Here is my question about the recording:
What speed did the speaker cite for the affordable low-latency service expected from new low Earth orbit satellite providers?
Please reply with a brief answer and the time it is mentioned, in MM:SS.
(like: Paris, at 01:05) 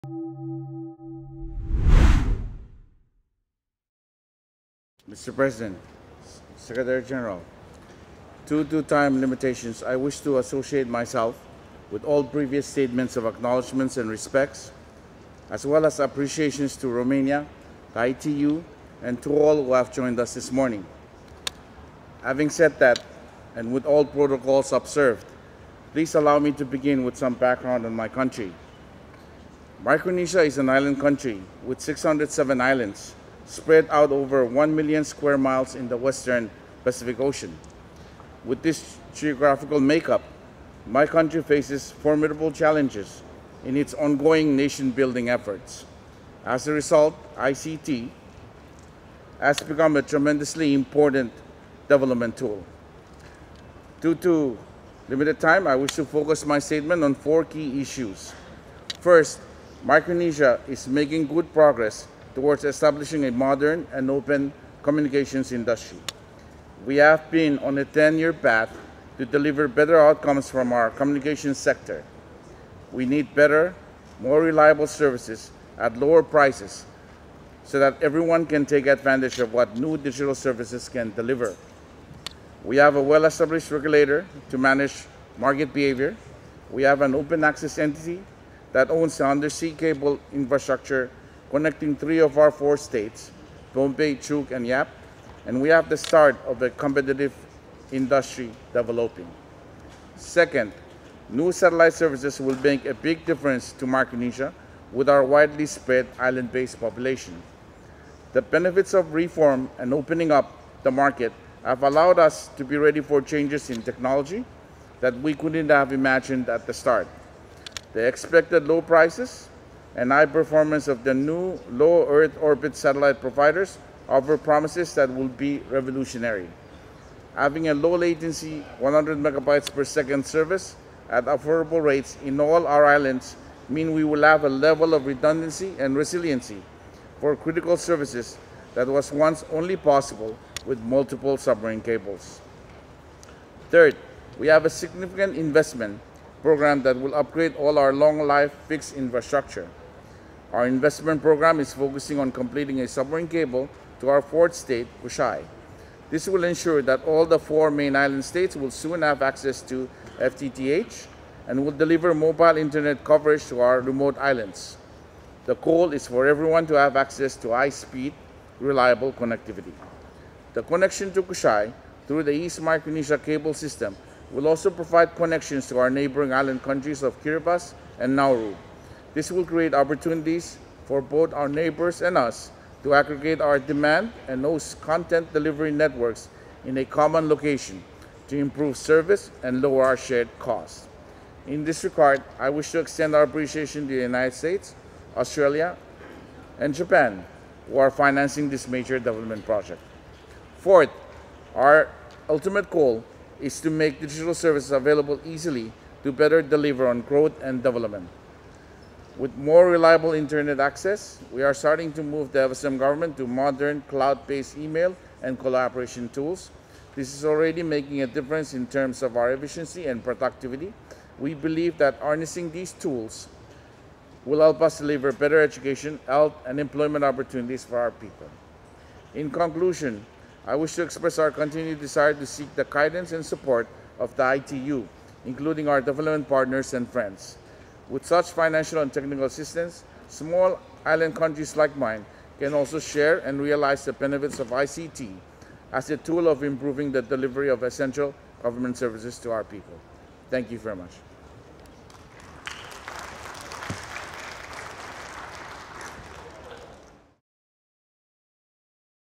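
100 megabytes per second, at 02:08.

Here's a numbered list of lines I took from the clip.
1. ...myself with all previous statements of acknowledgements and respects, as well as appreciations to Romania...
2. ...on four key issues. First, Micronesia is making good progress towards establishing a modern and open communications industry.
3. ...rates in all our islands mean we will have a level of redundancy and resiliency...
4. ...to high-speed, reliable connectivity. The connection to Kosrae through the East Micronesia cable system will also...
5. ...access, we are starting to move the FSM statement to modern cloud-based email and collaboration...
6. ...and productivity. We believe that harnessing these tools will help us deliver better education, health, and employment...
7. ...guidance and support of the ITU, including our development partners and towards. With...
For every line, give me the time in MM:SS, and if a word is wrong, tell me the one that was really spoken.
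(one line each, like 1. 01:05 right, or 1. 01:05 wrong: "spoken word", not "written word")
1. 00:10 right
2. 00:57 right
3. 02:11 right
4. 02:47 right
5. 03:30 wrong: "government", not "statement"
6. 03:39 right
7. 03:52 wrong: "friends", not "towards".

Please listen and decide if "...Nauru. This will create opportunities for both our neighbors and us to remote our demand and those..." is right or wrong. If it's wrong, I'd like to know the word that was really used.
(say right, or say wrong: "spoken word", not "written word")
wrong: "aggregate", not "remote".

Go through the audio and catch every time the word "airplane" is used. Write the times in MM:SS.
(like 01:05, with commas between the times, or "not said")
not said.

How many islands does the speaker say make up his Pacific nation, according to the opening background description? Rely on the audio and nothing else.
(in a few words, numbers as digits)
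607.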